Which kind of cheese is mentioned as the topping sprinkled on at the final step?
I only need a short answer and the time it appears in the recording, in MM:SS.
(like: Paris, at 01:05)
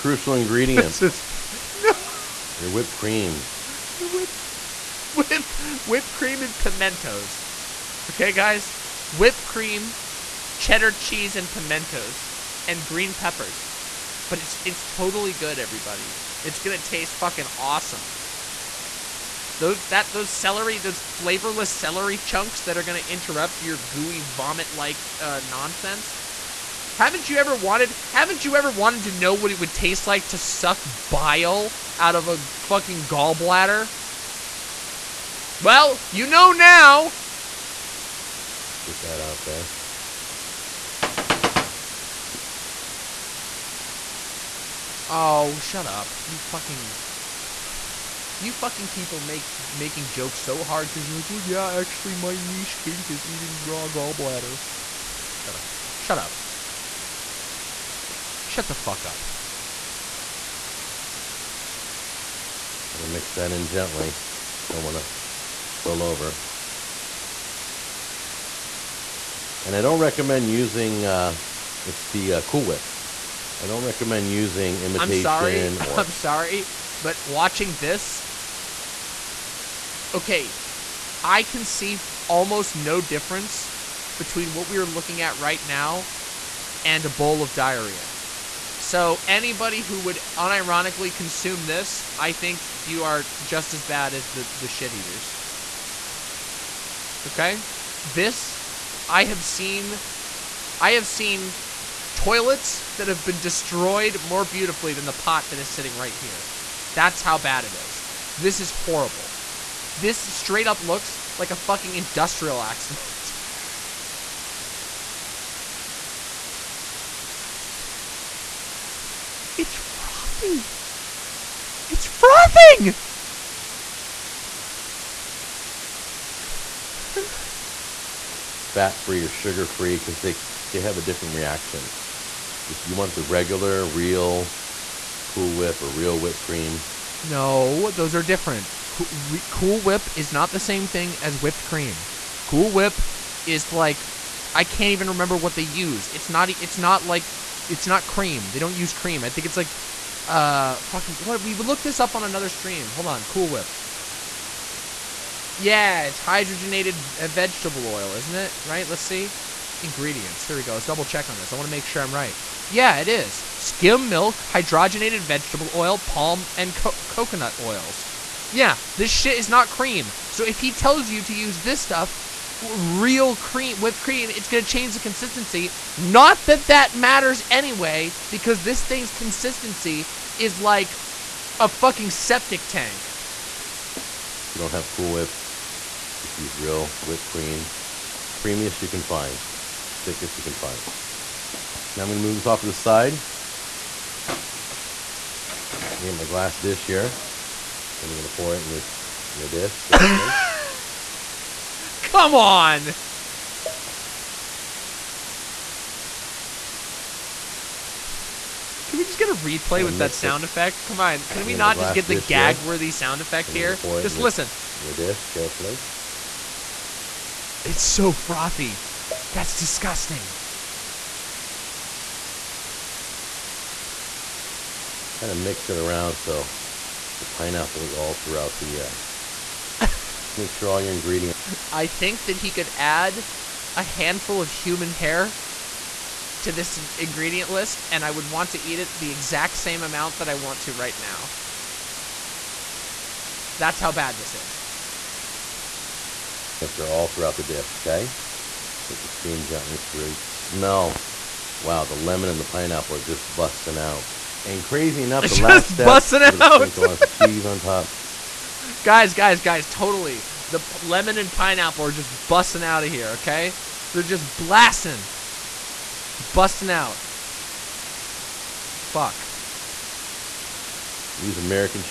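American, at 04:31.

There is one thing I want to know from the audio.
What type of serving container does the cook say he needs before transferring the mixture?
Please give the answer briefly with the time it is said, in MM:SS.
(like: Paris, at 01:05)
Glass dish, at 03:16.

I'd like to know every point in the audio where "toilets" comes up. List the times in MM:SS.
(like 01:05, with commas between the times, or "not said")
01:42.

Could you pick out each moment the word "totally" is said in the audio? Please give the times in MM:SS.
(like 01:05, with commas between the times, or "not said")
00:14, 04:19.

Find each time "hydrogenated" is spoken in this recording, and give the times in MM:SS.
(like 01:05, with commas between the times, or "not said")
02:36, 02:44.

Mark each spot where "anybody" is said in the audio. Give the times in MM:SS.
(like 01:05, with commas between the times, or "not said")
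01:29.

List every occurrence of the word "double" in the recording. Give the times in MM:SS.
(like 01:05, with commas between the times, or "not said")
02:40.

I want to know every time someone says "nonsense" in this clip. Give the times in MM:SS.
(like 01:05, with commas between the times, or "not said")
00:25.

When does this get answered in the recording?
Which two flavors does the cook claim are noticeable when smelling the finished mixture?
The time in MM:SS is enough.
04:11.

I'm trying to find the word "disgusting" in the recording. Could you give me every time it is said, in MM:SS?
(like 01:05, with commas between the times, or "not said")
03:39.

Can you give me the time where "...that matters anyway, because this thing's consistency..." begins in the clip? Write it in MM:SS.
02:56.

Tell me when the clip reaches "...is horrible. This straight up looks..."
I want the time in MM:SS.
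01:48.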